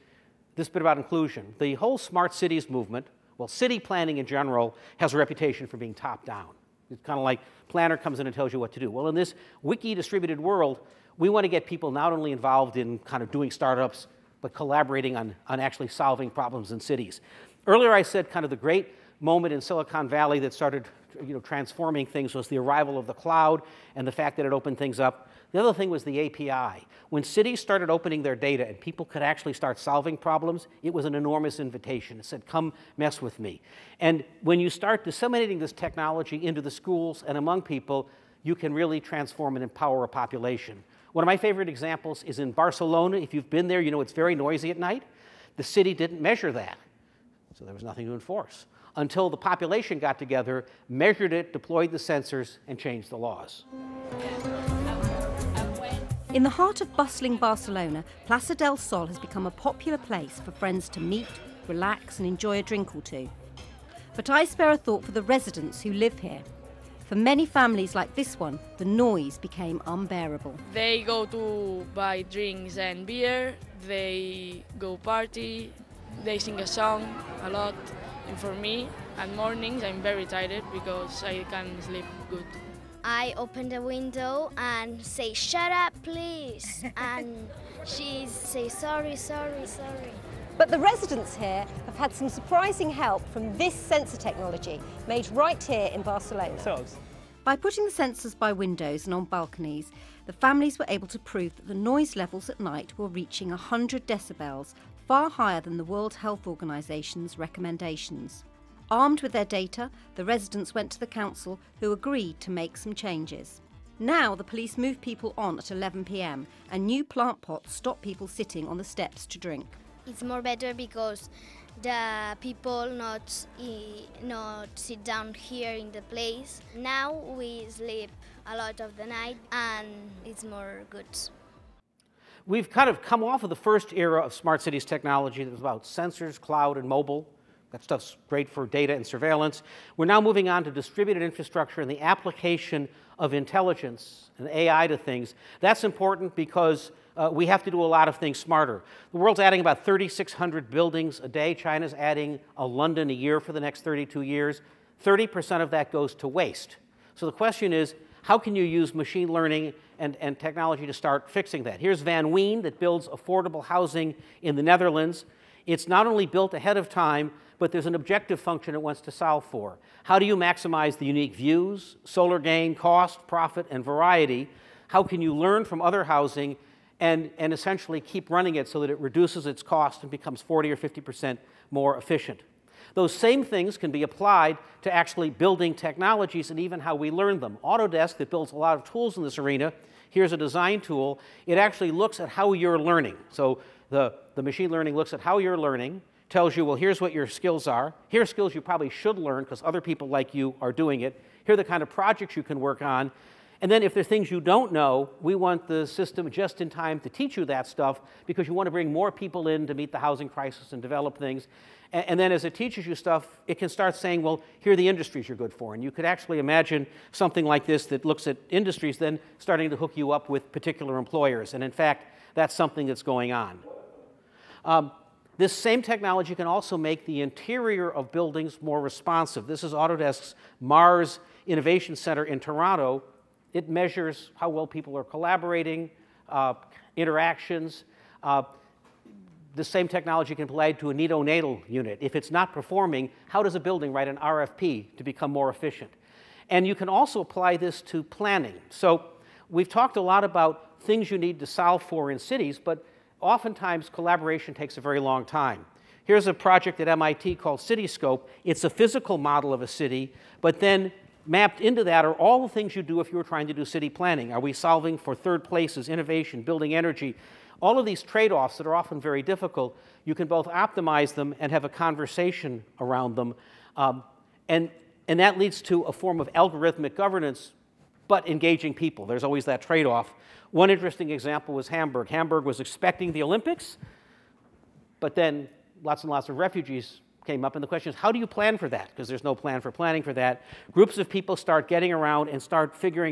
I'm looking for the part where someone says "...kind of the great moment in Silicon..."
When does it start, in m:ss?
0:18.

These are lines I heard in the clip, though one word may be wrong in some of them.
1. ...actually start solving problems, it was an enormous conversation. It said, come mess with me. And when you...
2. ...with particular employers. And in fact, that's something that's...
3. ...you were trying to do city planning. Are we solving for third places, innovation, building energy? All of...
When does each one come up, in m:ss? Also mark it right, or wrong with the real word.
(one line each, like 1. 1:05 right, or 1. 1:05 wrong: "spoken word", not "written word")
1. 0:29 wrong: "invitation", not "conversation"
2. 3:40 right
3. 4:23 right.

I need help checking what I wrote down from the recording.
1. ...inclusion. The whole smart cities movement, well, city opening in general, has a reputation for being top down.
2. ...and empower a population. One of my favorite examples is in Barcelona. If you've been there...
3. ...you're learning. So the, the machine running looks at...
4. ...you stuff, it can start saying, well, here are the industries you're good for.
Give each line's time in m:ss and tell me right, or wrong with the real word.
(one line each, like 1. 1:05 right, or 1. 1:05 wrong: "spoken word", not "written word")
1. 0:00 wrong: "planning", not "opening"
2. 0:39 right
3. 3:12 wrong: "learning", not "running"
4. 3:32 right.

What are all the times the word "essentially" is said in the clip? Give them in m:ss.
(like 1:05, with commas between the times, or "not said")
2:57.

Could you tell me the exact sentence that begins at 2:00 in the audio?
It's more better because the people not not sit down here in the place.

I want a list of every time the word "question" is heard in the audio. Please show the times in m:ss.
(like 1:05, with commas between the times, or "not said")
2:37, 4:47.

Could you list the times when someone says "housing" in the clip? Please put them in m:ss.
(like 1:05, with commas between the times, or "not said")
2:43, 2:56, 3:29.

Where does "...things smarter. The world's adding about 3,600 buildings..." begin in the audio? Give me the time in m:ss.
2:28.